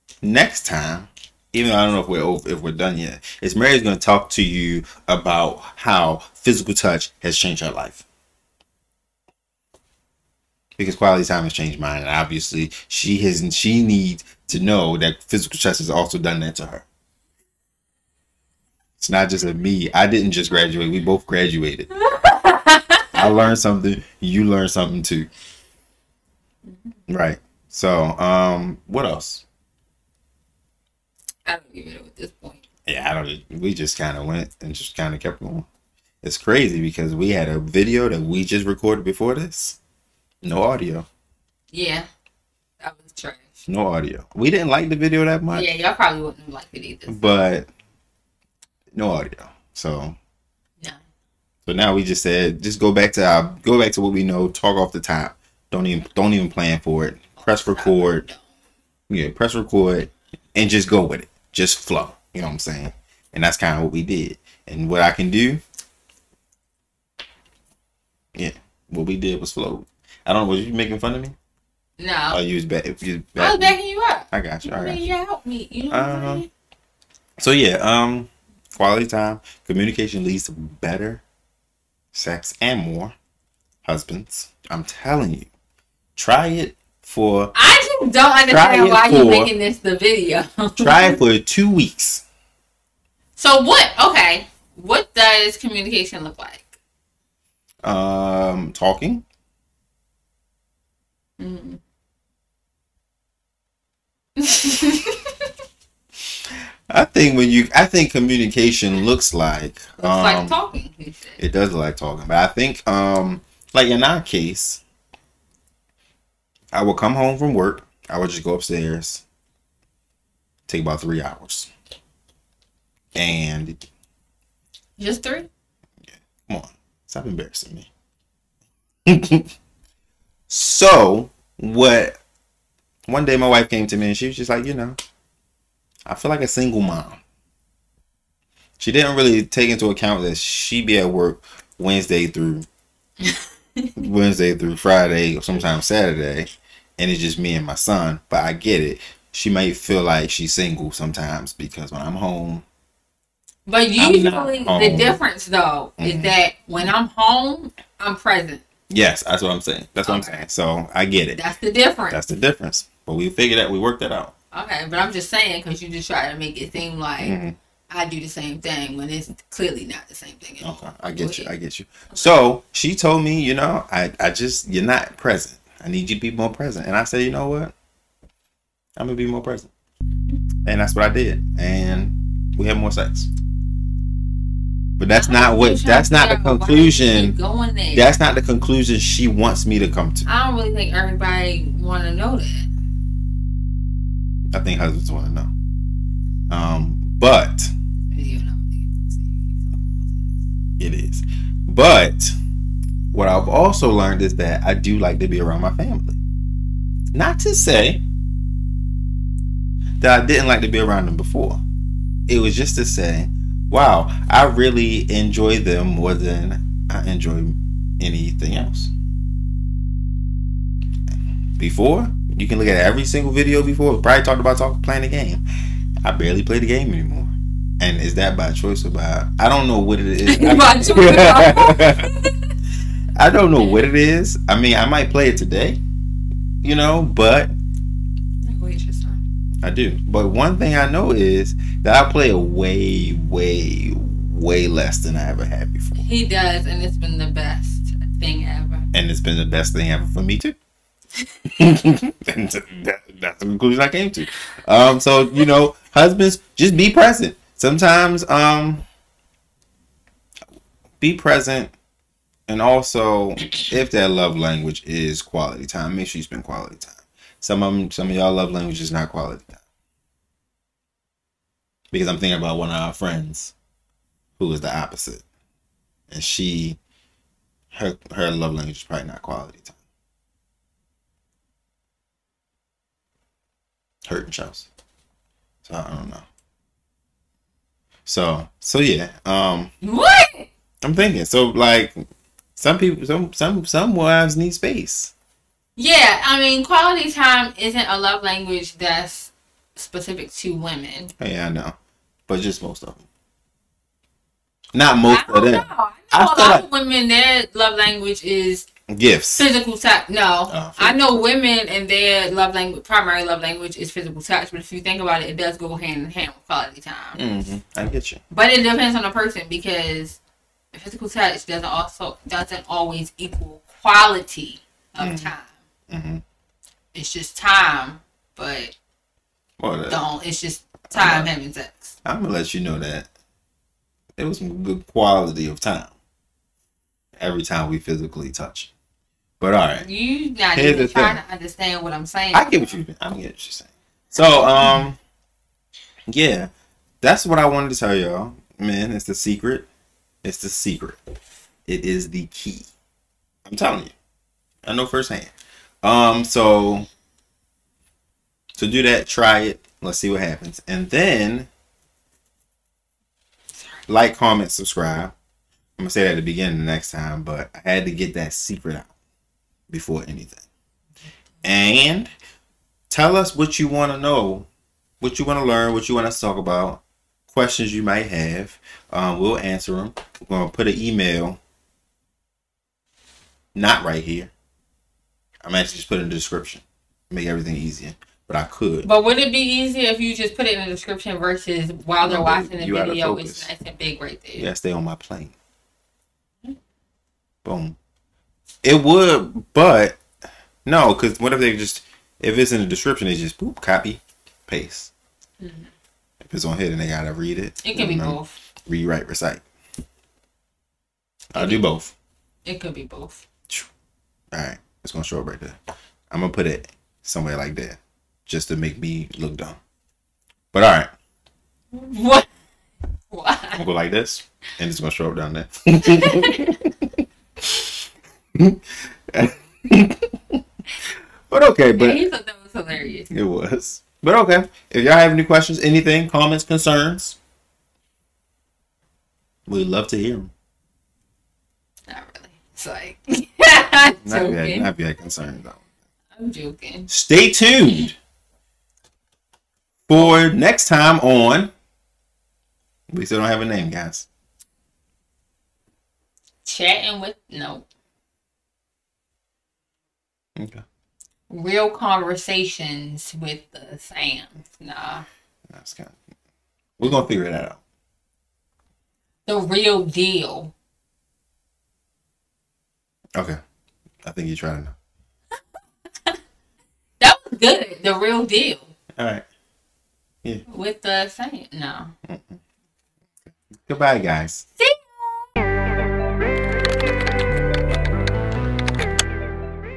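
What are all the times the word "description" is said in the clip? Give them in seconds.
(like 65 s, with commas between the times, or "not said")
386 s, 390 s, 402 s.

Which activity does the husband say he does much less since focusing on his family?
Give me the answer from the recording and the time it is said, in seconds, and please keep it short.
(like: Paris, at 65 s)
Playing the game, at 224 s.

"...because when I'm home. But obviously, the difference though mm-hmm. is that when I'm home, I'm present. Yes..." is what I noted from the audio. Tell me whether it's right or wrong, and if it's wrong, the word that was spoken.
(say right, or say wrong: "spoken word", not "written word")
wrong: "usually", not "obviously".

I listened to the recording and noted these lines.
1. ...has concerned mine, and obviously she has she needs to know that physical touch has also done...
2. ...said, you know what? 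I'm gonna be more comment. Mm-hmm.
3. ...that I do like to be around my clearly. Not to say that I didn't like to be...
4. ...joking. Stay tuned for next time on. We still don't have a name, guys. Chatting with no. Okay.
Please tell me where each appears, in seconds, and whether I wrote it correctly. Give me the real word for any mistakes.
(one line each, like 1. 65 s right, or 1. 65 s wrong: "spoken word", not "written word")
1. 11 s wrong: "changed", not "concerned"
2. 177 s wrong: "present", not "comment"
3. 204 s wrong: "family", not "clearly"
4. 446 s right.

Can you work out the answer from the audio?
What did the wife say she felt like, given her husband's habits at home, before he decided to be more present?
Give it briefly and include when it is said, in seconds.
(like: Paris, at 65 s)
A single mom, at 136 s.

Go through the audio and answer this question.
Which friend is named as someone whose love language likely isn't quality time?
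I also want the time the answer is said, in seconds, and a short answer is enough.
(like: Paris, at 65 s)
Chelsea, at 284 s.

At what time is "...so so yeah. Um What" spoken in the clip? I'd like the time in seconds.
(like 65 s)
288 s.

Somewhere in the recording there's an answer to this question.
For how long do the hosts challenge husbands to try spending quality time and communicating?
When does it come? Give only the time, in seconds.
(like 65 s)
91 s.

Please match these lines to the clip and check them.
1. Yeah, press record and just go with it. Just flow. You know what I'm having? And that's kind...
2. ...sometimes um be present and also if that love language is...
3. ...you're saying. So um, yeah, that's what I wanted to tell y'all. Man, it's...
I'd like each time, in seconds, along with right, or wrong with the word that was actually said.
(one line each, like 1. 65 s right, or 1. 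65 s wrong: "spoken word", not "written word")
1. 59 s wrong: "saying", not "having"
2. 257 s right
3. 343 s right.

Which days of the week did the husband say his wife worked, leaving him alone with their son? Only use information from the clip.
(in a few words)
Wednesday through Friday.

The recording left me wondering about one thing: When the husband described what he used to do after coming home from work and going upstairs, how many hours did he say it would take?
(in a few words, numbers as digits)
3.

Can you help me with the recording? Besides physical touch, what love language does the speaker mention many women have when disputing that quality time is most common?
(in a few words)
Gifts.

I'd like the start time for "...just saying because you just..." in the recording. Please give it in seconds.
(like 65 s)
165 s.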